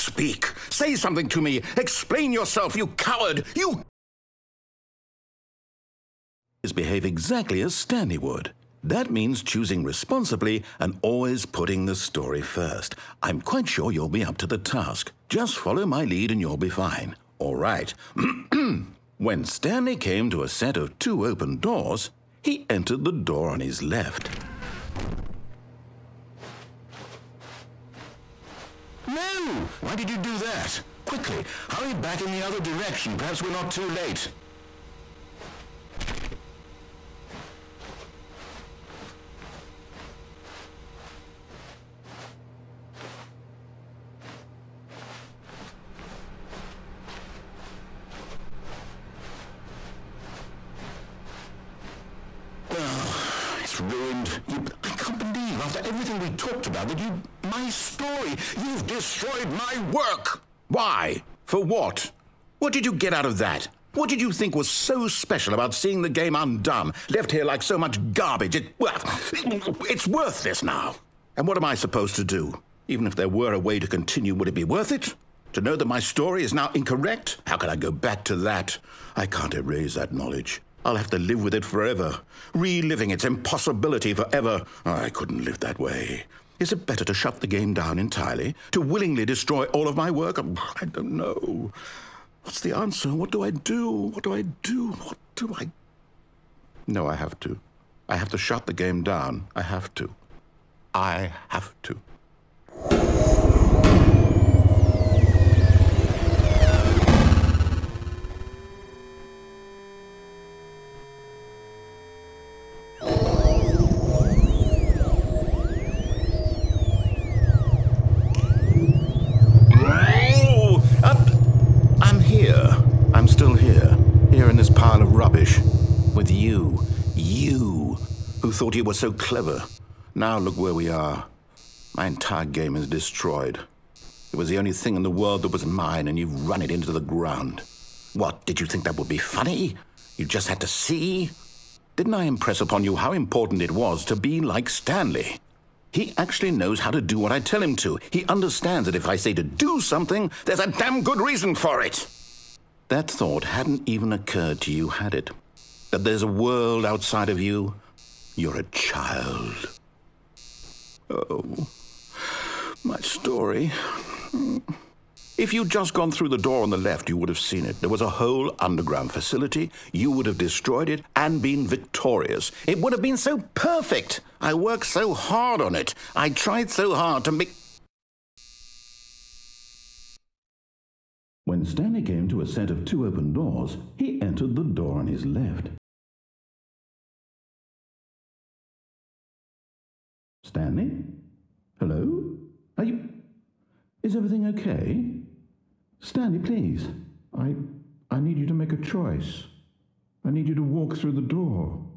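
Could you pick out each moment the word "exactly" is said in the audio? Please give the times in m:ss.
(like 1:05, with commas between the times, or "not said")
0:07.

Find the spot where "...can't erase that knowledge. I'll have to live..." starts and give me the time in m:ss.
1:19.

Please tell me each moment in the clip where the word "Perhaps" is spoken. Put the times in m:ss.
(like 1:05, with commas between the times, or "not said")
0:33.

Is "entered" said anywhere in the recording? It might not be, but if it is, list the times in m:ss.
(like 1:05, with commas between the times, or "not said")
0:22, 3:04.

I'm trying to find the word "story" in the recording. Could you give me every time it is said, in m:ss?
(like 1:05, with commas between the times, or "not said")
0:11, 0:57, 1:15, 2:42.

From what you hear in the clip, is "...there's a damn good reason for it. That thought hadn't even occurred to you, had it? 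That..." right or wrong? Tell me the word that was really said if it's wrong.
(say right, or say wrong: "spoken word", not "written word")
right.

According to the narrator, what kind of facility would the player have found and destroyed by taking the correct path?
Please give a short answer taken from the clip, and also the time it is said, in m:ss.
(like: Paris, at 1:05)
Underground facility, at 2:48.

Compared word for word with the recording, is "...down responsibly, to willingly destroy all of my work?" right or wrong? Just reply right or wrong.
wrong.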